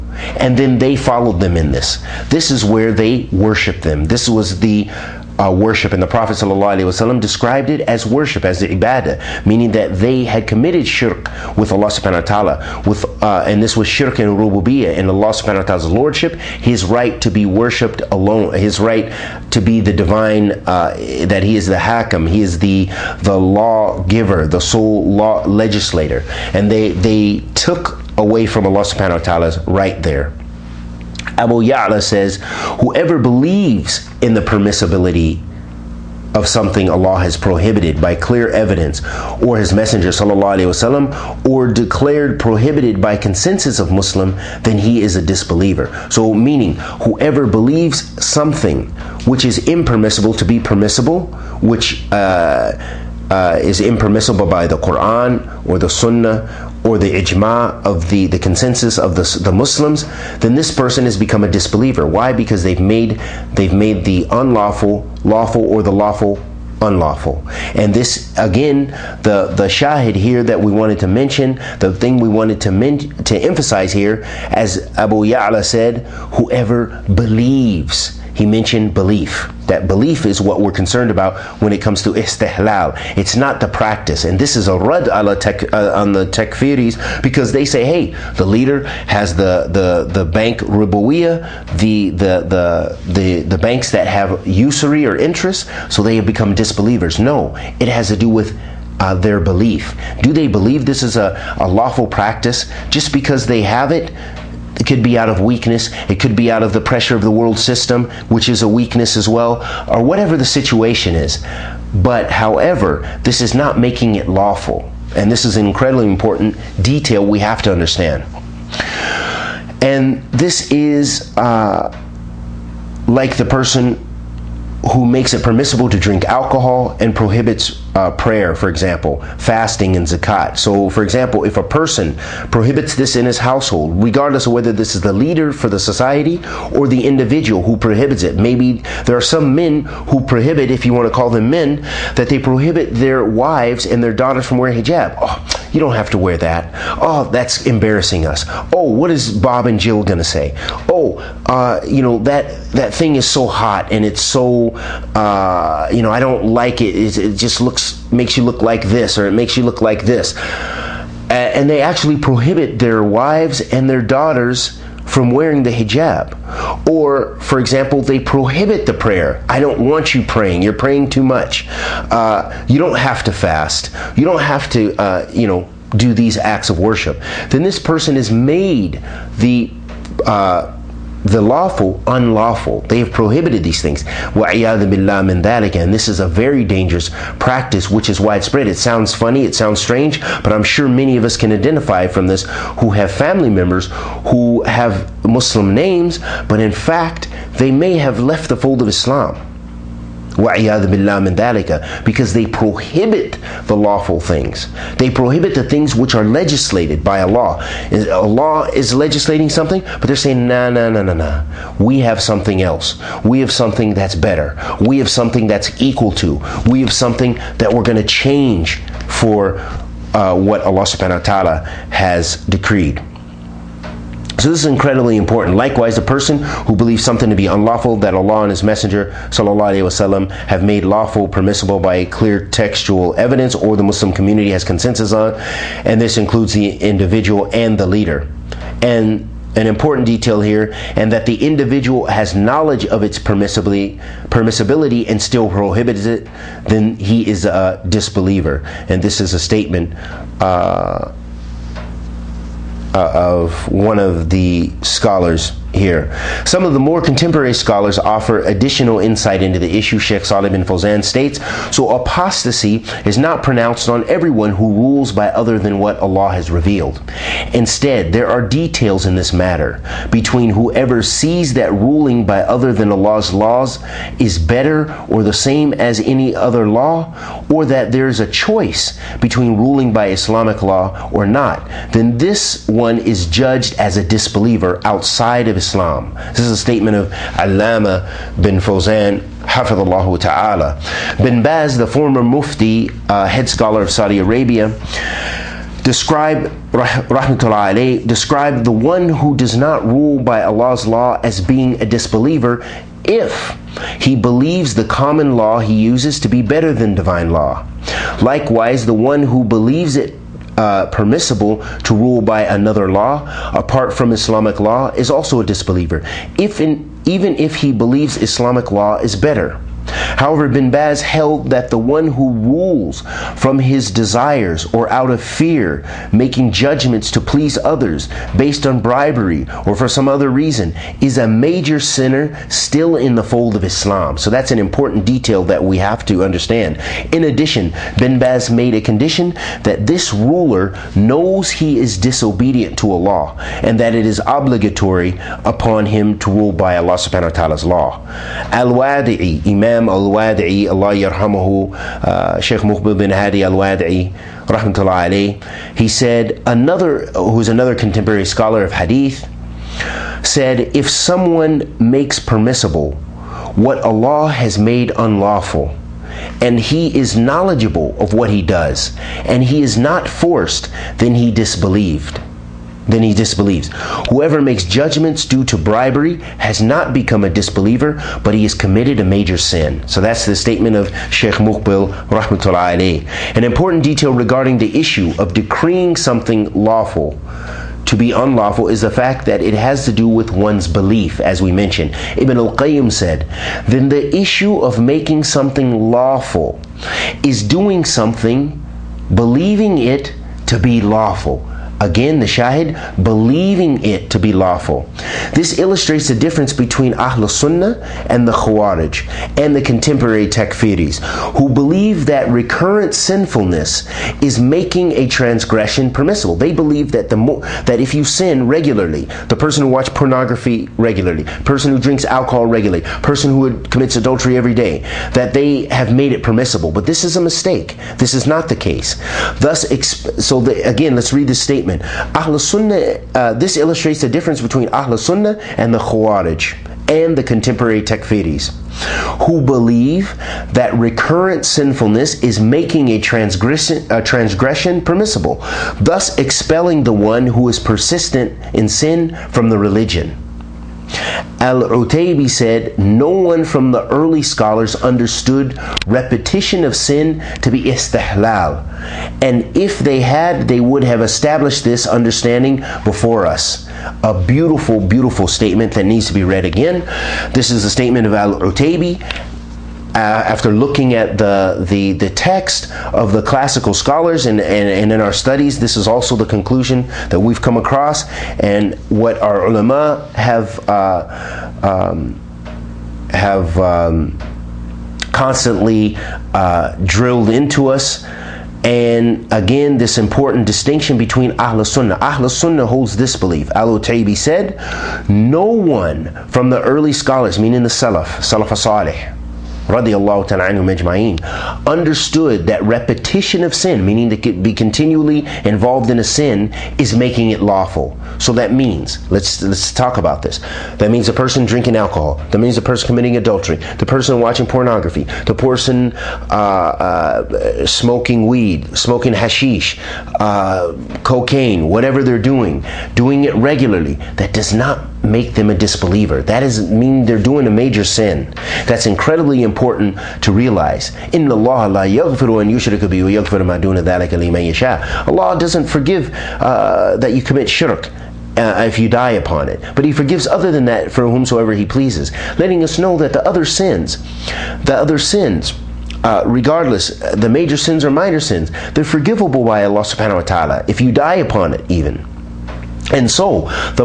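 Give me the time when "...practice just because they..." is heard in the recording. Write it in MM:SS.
01:42.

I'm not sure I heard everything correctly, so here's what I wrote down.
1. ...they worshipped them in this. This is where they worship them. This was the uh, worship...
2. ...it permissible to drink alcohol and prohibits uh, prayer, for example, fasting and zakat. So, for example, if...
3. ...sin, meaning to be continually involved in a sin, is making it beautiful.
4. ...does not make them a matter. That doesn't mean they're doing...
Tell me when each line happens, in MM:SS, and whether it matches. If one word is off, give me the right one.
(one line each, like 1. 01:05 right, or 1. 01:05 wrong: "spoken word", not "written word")
1. 00:00 wrong: "followed", not "worshipped"
2. 02:05 right
3. 08:23 wrong: "lawful", not "beautiful"
4. 08:44 wrong: "disbeliever", not "matter".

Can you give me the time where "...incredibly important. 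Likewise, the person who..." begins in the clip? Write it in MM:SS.
03:44.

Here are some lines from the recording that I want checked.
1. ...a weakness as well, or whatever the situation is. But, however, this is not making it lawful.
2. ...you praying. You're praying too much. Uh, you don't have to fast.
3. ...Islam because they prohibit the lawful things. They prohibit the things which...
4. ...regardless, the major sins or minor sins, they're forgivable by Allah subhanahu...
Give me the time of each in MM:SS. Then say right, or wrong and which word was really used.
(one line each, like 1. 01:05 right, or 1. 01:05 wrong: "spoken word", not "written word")
1. 01:48 right
2. 02:50 right
3. 03:18 right
4. 09:06 right.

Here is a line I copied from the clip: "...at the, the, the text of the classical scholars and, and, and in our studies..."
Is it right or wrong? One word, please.
right.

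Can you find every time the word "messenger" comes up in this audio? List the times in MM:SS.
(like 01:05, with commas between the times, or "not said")
00:39, 03:48.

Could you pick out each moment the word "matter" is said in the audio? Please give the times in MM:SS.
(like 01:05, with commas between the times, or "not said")
04:29.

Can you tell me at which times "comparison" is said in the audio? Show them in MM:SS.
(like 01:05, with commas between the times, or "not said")
not said.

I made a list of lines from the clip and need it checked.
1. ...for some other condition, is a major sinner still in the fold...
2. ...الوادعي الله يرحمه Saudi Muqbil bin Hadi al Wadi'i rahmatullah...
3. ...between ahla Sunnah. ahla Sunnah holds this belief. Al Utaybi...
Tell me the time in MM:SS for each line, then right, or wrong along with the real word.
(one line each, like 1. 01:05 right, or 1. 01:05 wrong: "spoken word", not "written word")
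1. 05:29 wrong: "reason", not "condition"
2. 05:49 wrong: "Sheikh", not "Saudi"
3. 08:10 right.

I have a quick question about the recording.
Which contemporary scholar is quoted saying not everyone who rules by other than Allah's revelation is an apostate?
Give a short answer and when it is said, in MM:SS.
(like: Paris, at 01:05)
Salih bin Fawzan, at 04:19.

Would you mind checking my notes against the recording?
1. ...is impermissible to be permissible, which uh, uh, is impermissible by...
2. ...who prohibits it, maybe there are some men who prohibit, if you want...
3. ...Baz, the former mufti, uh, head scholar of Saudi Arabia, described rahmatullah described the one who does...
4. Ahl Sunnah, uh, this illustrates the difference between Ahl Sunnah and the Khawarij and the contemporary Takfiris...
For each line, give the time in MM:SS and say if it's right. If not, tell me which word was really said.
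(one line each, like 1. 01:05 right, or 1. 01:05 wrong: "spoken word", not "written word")
1. 00:49 right
2. 02:17 right
3. 04:51 right
4. 07:12 right.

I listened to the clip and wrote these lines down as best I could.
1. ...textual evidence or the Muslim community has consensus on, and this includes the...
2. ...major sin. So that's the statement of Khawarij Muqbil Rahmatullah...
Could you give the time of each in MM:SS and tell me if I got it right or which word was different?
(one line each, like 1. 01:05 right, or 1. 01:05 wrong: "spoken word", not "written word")
1. 03:52 right
2. 06:19 wrong: "Sheikh", not "Khawarij".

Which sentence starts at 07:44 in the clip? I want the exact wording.
A beautiful, beautiful statement that needs to be read again.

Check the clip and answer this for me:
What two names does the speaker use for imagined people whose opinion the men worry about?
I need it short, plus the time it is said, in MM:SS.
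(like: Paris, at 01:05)
Bob and Jill, at 02:29.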